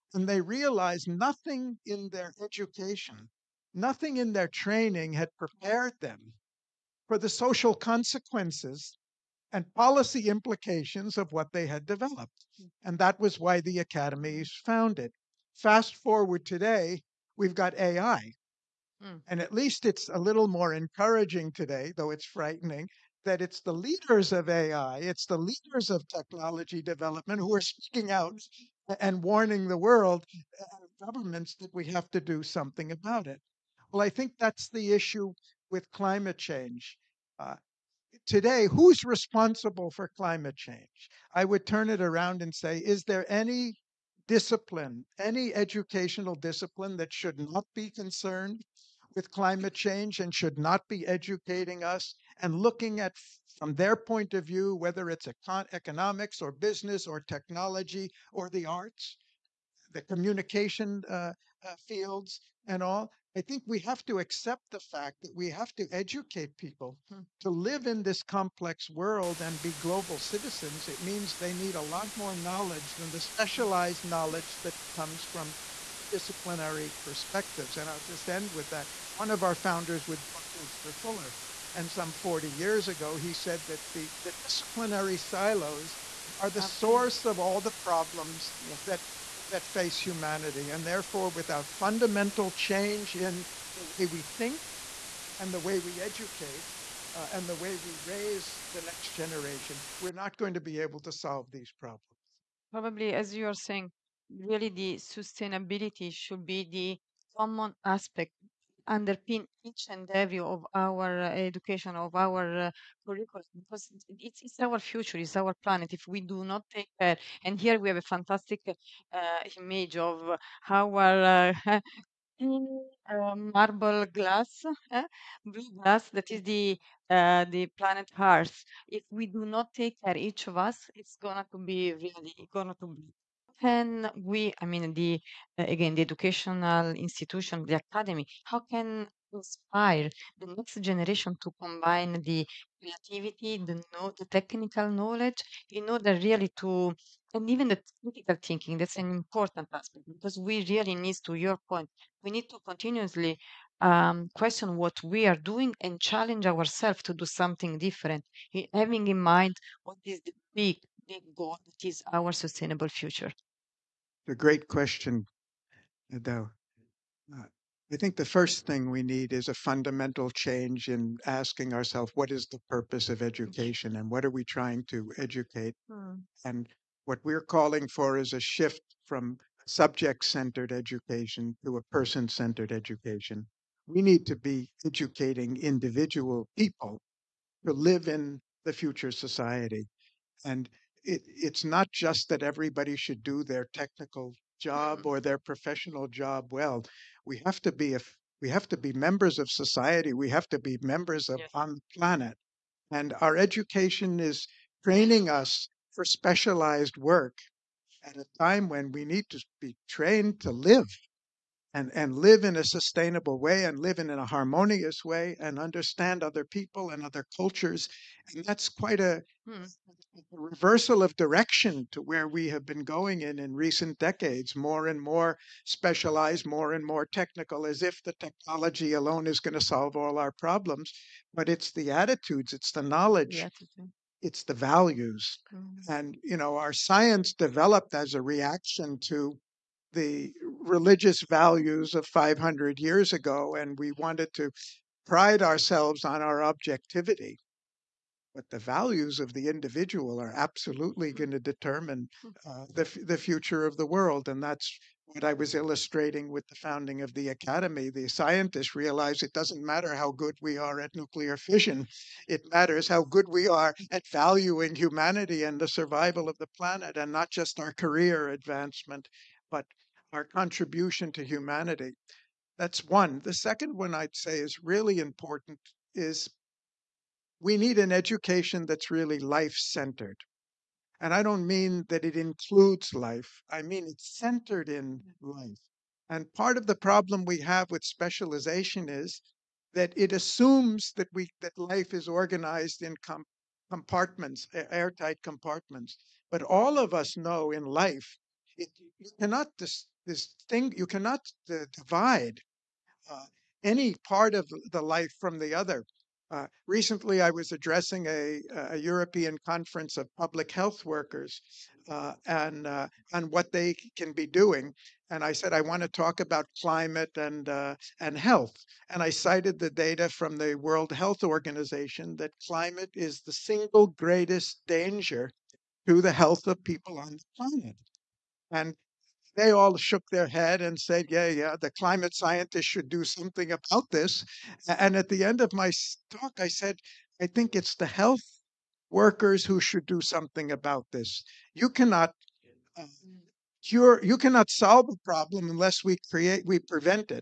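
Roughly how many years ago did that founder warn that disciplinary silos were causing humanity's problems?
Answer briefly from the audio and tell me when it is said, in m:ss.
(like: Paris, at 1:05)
40, at 1:22.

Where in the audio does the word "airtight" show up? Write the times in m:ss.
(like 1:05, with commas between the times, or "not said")
4:54.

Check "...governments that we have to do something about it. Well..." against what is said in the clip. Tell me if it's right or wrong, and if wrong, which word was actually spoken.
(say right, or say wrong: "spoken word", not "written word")
right.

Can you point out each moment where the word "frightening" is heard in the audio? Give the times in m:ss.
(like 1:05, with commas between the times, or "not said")
0:22.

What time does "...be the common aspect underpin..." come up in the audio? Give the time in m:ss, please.
1:46.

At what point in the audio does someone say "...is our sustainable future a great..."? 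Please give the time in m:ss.
2:41.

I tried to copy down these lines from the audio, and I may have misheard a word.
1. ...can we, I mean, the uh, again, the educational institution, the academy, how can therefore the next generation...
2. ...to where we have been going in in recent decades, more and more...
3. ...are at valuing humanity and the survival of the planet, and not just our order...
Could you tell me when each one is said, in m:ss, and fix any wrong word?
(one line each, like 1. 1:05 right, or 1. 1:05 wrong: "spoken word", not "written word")
1. 2:13 wrong: "inspire", not "therefore"
2. 3:41 right
3. 4:23 wrong: "career", not "order".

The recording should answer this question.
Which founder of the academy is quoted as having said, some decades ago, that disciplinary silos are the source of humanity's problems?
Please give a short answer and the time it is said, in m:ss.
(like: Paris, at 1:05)
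Buckminster Fuller, at 1:20.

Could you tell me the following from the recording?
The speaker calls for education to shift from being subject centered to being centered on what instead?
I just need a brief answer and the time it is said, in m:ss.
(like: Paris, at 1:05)
person centered, at 3:01.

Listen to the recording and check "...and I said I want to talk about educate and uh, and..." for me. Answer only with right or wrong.
wrong.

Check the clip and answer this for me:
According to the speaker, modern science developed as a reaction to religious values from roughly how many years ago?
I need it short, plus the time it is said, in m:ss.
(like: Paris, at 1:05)
500, at 4:02.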